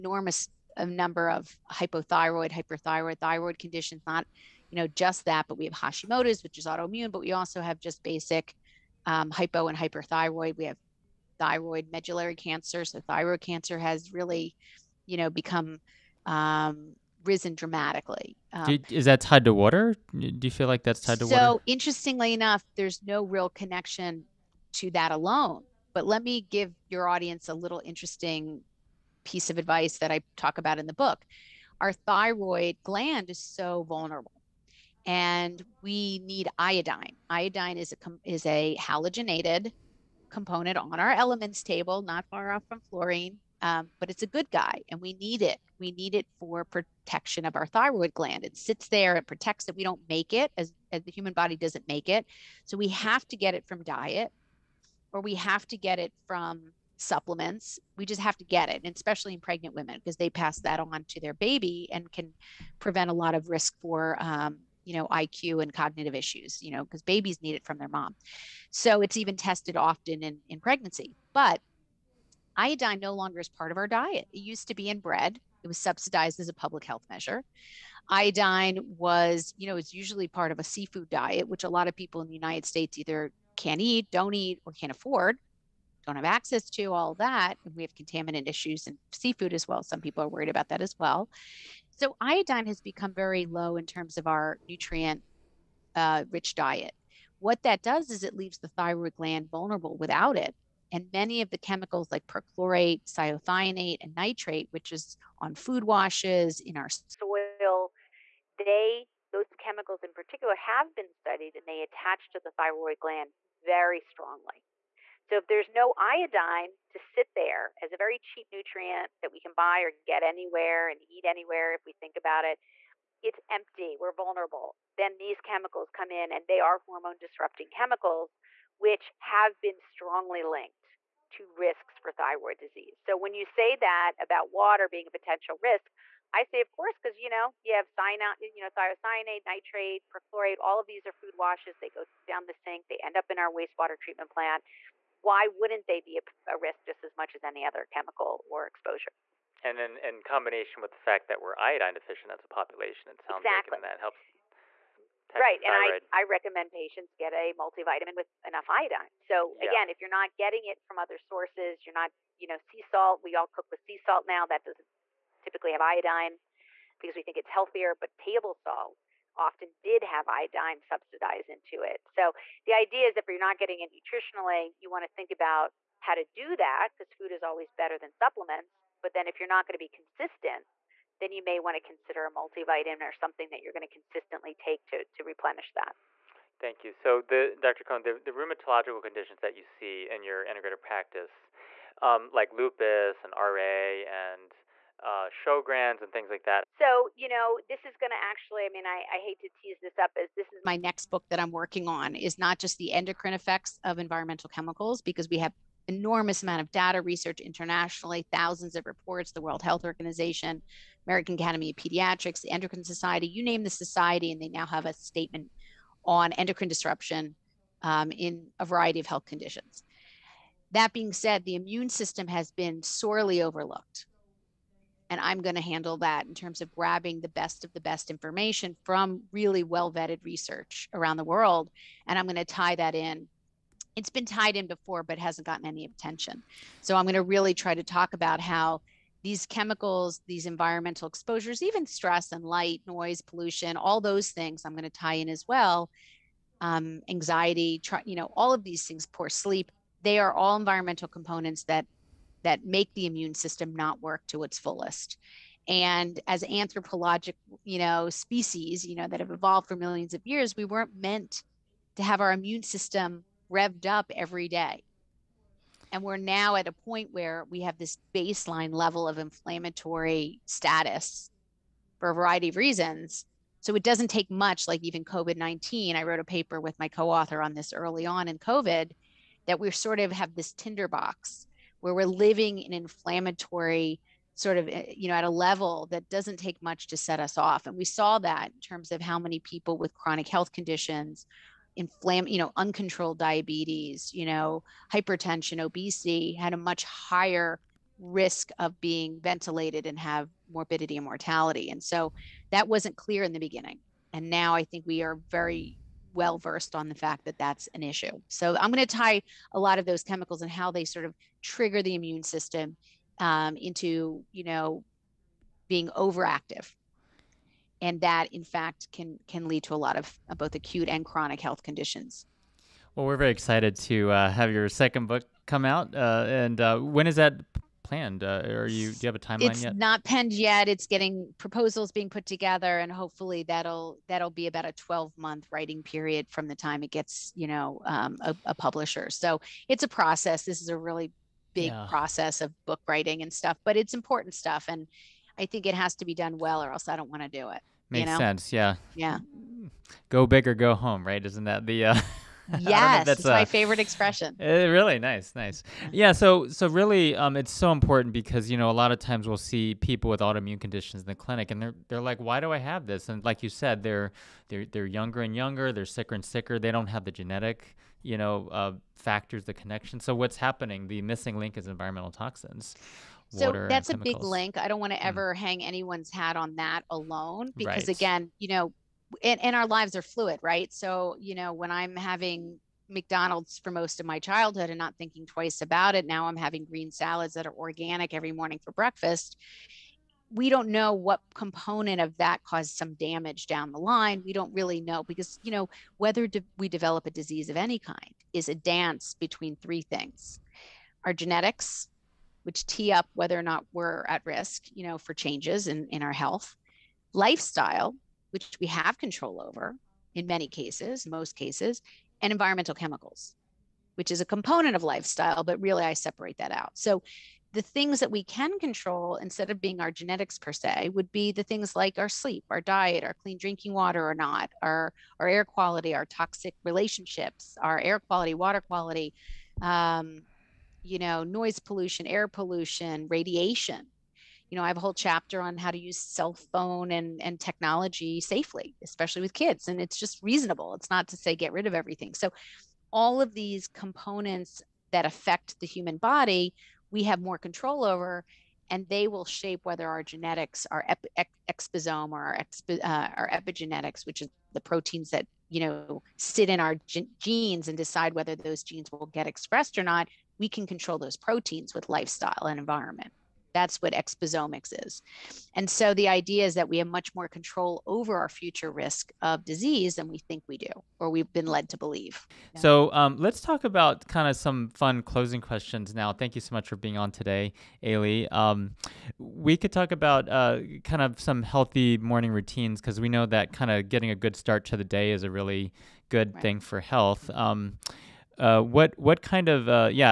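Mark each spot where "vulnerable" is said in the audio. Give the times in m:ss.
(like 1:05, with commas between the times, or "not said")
0:33, 1:39, 2:04.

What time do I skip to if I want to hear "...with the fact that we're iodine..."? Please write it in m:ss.
2:30.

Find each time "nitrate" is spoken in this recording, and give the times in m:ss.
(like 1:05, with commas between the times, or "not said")
1:44, 2:19.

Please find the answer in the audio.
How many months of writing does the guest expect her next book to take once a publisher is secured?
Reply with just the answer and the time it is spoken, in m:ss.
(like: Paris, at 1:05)
12, at 5:34.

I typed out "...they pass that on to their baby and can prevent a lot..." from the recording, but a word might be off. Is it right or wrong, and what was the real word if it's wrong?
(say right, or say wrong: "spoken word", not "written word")
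right.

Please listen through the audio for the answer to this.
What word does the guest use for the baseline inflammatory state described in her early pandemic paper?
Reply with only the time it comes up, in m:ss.
4:40.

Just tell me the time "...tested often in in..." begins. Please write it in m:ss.
1:09.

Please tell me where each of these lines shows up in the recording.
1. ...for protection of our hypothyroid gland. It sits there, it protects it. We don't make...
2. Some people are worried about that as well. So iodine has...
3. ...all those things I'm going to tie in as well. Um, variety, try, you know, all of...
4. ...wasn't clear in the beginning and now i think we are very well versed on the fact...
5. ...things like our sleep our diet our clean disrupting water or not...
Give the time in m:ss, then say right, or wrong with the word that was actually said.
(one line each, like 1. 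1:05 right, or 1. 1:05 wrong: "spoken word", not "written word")
1. 0:46 wrong: "thyroid", not "hypothyroid"
2. 1:29 right
3. 4:03 wrong: "anxiety", not "variety"
4. 5:02 right
5. 7:01 wrong: "drinking", not "disrupting".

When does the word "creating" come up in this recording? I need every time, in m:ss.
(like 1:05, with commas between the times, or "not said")
not said.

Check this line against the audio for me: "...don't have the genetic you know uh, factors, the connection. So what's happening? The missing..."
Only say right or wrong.
right.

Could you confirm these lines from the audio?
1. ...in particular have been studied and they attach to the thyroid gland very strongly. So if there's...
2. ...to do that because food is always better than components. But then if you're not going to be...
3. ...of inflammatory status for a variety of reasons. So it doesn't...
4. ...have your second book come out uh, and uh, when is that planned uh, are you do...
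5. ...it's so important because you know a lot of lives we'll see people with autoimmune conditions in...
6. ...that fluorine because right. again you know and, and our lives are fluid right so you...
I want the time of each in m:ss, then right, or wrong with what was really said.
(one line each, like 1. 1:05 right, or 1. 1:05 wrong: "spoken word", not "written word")
1. 1:50 right
2. 2:56 wrong: "supplements", not "components"
3. 4:29 right
4. 5:24 right
5. 5:57 wrong: "times", not "lives"
6. 6:16 wrong: "alone", not "fluorine".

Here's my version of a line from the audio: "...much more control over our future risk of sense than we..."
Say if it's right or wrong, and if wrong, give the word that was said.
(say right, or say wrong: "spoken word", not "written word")
wrong: "disease", not "sense".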